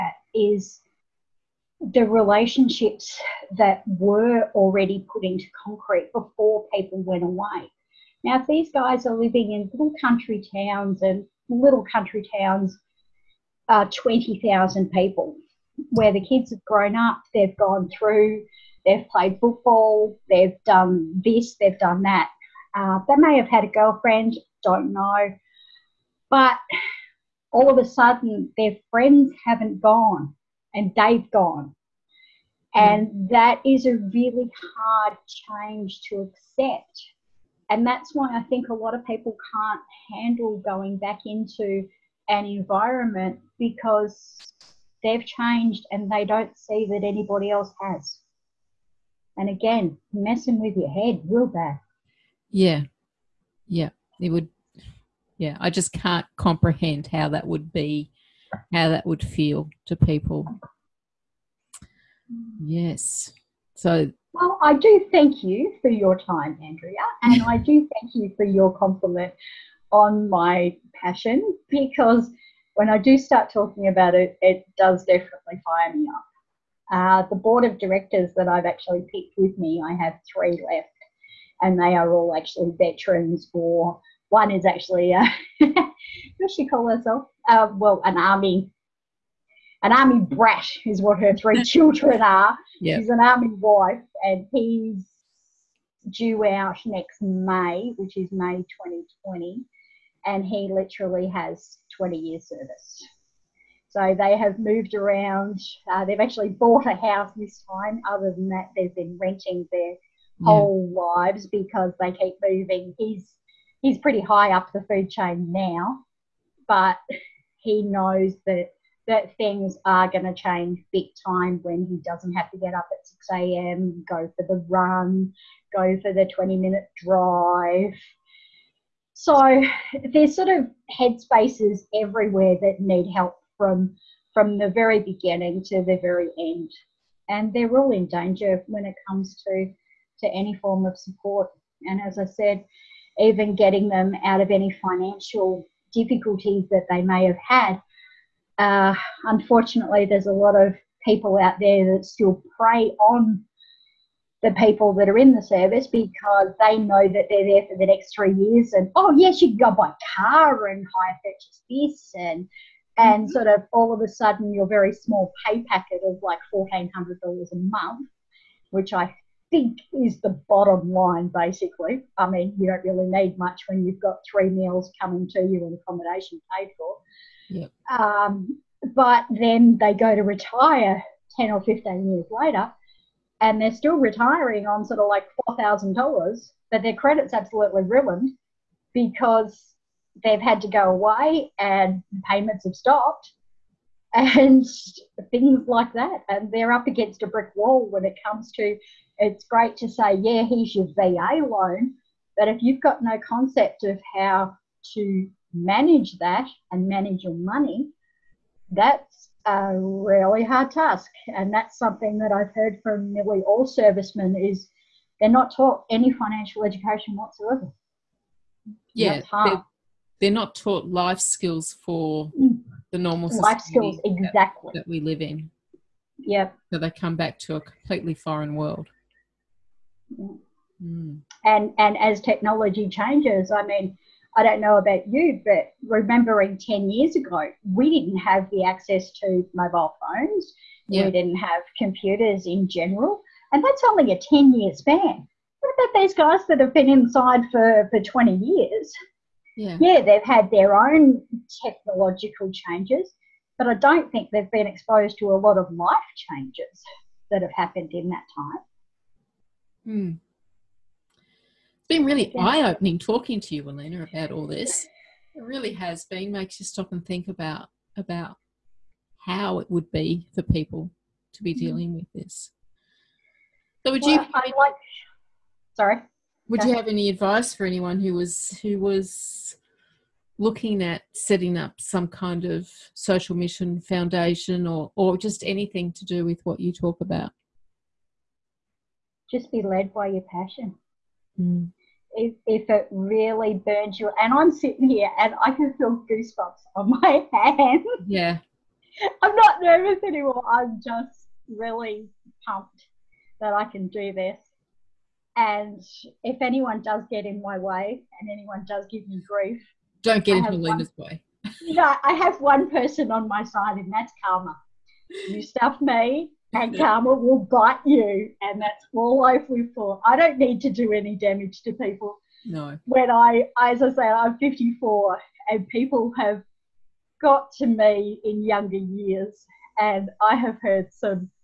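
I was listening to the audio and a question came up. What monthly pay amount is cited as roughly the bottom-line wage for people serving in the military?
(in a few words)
$1,400.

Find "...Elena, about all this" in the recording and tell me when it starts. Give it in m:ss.
4:23.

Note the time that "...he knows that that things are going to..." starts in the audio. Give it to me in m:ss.
1:57.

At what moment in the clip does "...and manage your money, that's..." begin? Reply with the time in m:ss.
3:26.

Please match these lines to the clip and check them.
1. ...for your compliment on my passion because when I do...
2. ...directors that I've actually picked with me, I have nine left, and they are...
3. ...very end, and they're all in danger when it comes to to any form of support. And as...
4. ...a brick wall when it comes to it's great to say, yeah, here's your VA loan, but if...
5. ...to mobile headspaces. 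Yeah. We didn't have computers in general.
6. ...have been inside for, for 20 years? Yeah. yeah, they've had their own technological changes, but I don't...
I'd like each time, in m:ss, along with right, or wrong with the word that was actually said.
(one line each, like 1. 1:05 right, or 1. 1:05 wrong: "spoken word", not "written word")
1. 1:08 right
2. 1:17 wrong: "three", not "nine"
3. 2:16 right
4. 3:17 right
5. 3:59 wrong: "phones", not "headspaces"
6. 4:06 right.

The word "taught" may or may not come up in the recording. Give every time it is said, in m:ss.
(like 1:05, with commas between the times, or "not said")
3:35, 3:40.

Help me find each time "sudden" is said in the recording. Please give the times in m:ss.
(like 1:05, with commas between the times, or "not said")
0:27, 2:44.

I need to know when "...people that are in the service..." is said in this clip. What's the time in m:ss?
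2:34.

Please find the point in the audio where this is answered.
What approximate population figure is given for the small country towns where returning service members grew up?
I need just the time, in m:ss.
0:13.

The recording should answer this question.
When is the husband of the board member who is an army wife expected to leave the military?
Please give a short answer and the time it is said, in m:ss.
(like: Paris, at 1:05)
May 2020, at 1:38.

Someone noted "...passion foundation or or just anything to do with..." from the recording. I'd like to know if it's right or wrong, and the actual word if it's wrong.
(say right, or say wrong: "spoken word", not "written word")
wrong: "mission", not "passion".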